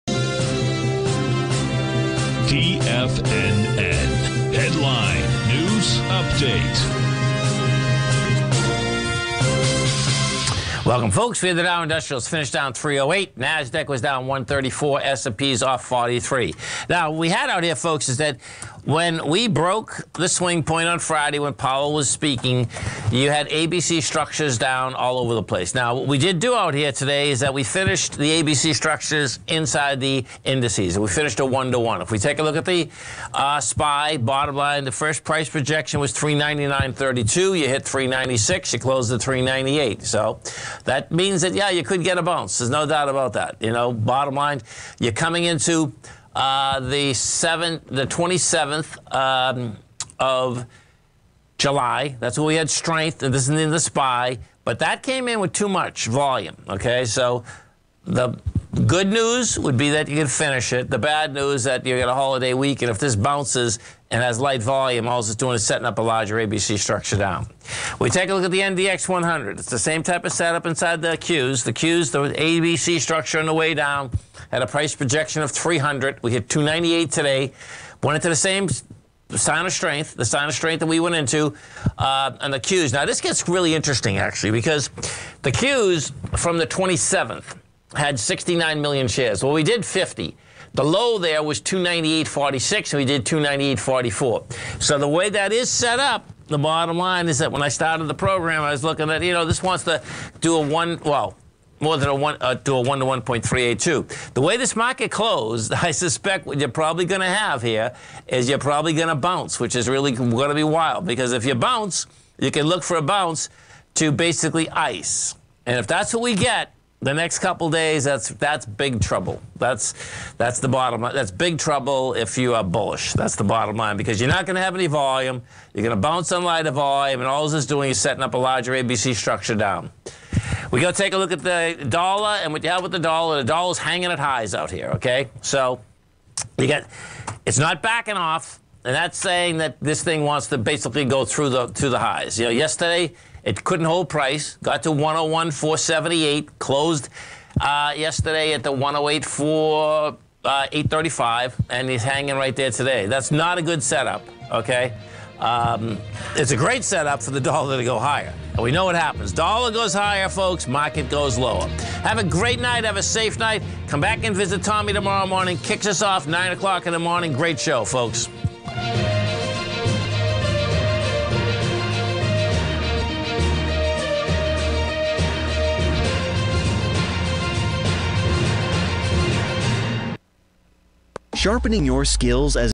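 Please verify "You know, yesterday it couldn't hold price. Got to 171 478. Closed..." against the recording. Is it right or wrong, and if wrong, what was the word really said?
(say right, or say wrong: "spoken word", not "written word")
wrong: "101", not "171".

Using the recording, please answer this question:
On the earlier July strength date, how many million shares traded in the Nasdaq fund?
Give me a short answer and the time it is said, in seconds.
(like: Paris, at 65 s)
69 million, at 88 s.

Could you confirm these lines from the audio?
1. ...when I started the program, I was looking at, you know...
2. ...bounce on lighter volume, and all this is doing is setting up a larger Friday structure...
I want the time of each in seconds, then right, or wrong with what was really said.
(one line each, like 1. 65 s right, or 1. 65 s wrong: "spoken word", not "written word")
1. 97 s right
2. 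126 s wrong: "ABC", not "Friday".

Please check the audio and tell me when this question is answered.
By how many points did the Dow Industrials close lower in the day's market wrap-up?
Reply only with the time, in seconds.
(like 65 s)
12 s.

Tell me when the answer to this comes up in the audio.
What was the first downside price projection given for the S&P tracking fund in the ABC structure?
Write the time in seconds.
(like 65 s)
36 s.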